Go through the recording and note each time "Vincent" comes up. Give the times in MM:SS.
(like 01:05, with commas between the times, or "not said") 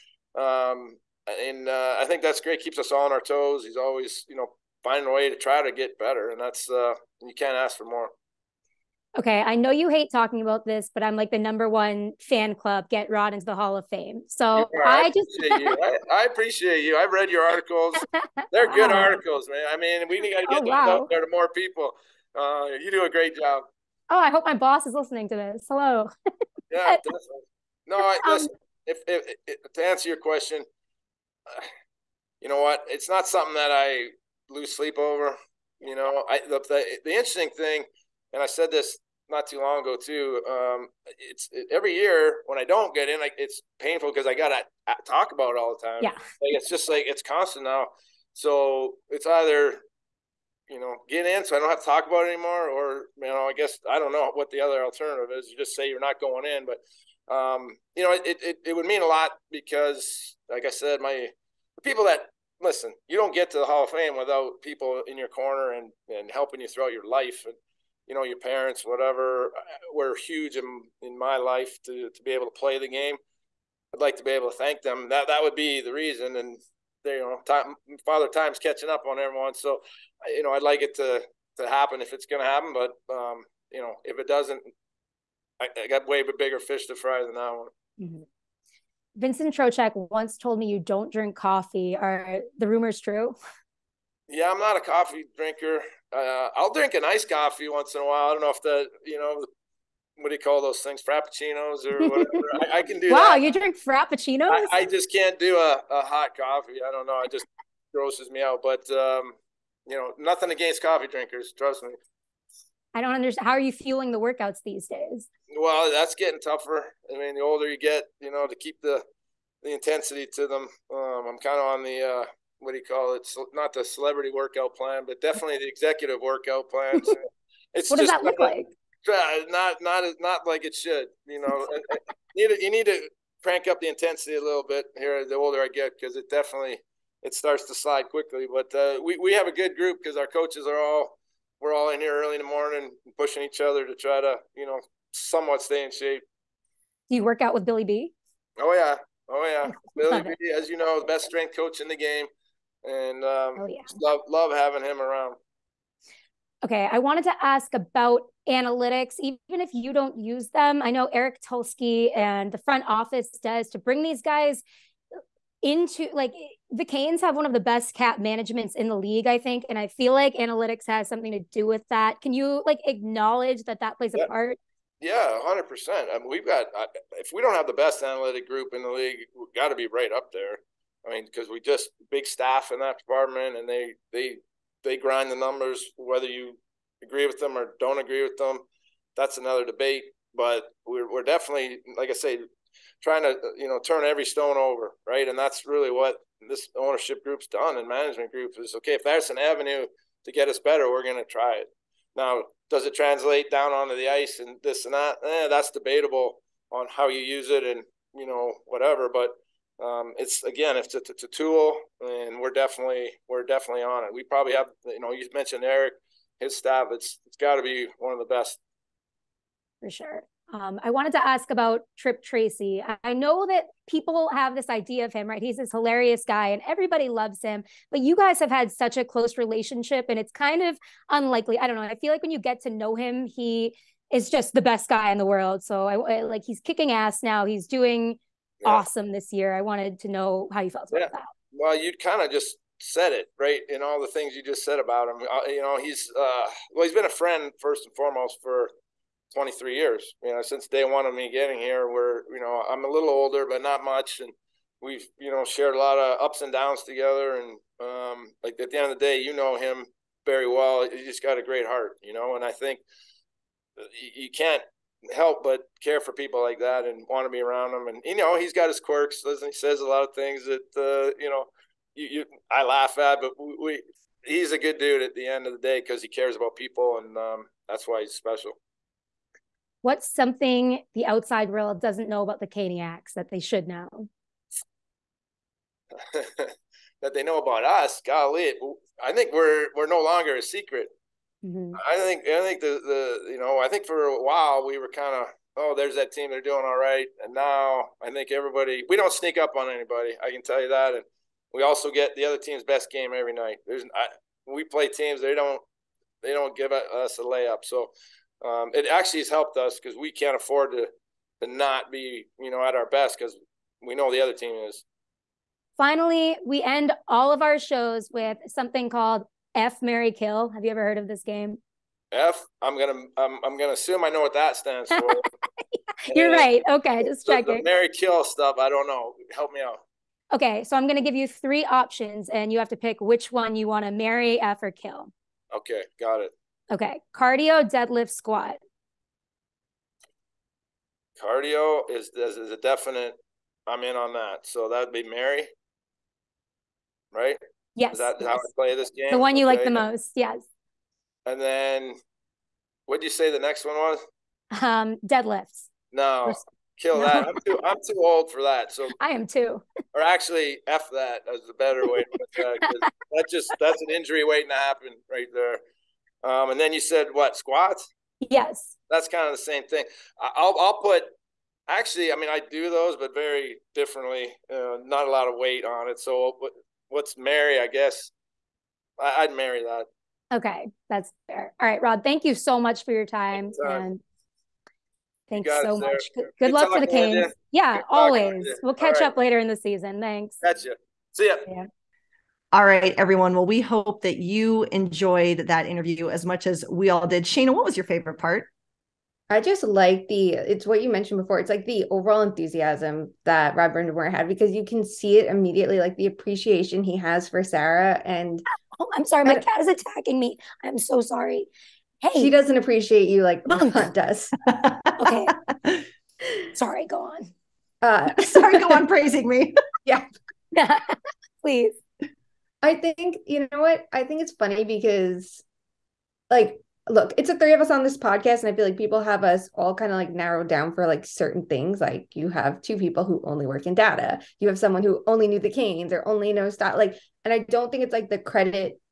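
01:29.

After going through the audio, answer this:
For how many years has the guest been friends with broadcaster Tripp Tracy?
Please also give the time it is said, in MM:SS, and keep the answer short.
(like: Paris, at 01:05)
23, at 04:09.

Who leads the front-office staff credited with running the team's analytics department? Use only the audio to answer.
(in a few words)
Eric Tulsky.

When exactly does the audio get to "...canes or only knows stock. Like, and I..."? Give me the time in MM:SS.
07:15.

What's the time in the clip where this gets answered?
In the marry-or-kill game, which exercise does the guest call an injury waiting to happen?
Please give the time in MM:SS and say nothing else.
05:55.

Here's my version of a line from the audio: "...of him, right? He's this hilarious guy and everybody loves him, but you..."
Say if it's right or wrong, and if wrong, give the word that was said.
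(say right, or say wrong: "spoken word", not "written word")
right.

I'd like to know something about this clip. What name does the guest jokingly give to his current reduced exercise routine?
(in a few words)
Executive workout plan.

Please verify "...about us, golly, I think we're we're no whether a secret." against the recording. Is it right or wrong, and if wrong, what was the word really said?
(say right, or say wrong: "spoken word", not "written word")
wrong: "longer", not "whether".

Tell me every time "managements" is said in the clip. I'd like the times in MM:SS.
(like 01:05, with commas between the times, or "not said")
02:48, 03:17.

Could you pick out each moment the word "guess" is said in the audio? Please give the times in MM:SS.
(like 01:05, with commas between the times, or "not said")
00:53, 06:17.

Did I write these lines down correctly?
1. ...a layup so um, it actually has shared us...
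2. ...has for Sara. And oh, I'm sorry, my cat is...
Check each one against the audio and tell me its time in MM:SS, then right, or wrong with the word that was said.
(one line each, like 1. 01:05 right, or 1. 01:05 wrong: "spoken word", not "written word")
1. 05:07 wrong: "helped", not "shared"
2. 06:46 right.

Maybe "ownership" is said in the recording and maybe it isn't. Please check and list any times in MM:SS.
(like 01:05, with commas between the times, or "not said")
03:16.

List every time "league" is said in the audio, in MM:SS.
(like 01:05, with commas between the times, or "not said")
02:48, 02:58.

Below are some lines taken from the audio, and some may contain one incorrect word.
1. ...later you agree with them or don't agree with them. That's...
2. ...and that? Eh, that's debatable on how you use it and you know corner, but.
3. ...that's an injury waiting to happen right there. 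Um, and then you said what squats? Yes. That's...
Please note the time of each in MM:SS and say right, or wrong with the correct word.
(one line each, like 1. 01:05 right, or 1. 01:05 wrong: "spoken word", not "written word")
1. 03:05 wrong: "whether", not "later"
2. 03:24 wrong: "whatever", not "corner"
3. 06:03 right.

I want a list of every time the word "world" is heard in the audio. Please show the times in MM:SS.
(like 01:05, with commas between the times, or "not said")
03:55, 04:41.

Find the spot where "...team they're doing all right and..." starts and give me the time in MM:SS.
04:56.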